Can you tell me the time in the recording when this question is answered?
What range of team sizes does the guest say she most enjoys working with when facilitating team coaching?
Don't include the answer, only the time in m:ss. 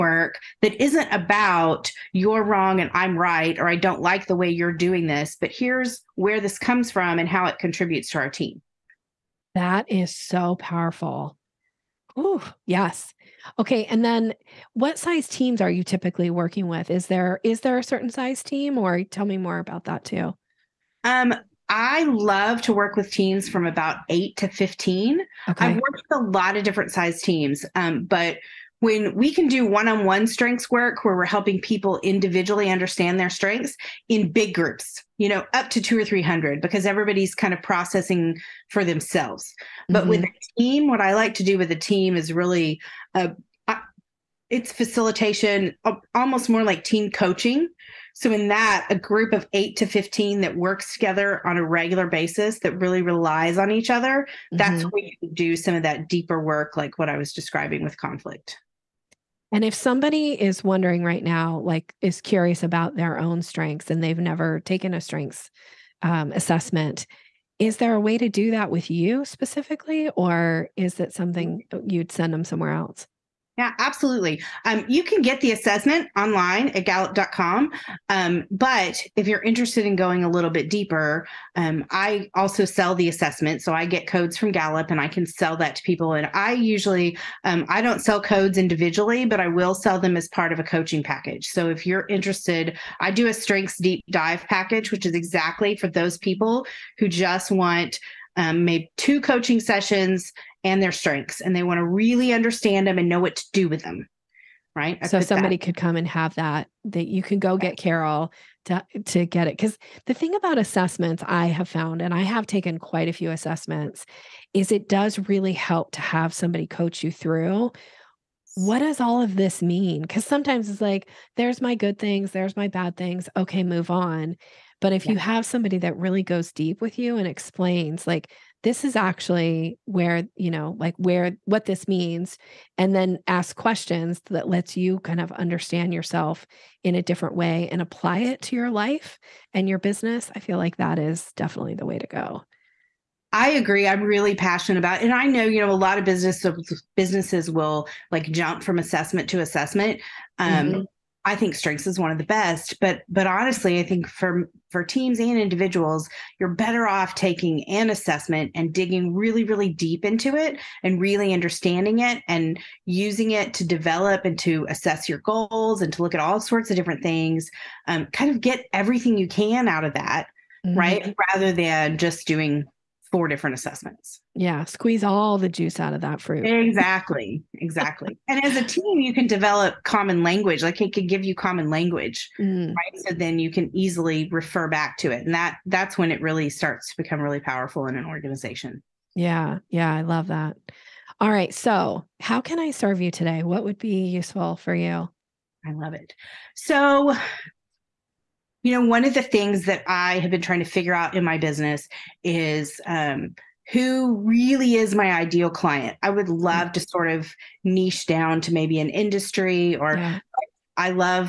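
0:23.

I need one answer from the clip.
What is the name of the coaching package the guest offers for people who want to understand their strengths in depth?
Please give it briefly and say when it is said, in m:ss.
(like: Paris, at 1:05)
strengths deep dive, at 1:33.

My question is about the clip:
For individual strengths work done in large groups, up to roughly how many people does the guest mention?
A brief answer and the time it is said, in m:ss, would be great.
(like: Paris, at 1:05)
300, at 0:35.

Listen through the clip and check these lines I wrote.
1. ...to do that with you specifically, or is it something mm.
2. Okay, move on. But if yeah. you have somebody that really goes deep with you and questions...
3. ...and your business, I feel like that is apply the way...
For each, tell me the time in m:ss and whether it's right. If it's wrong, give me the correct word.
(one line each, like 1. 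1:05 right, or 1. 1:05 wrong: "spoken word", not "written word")
1. 1:08 right
2. 2:03 wrong: "explains", not "questions"
3. 2:19 wrong: "definitely", not "apply".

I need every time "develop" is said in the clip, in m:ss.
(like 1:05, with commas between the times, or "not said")
2:43, 2:59.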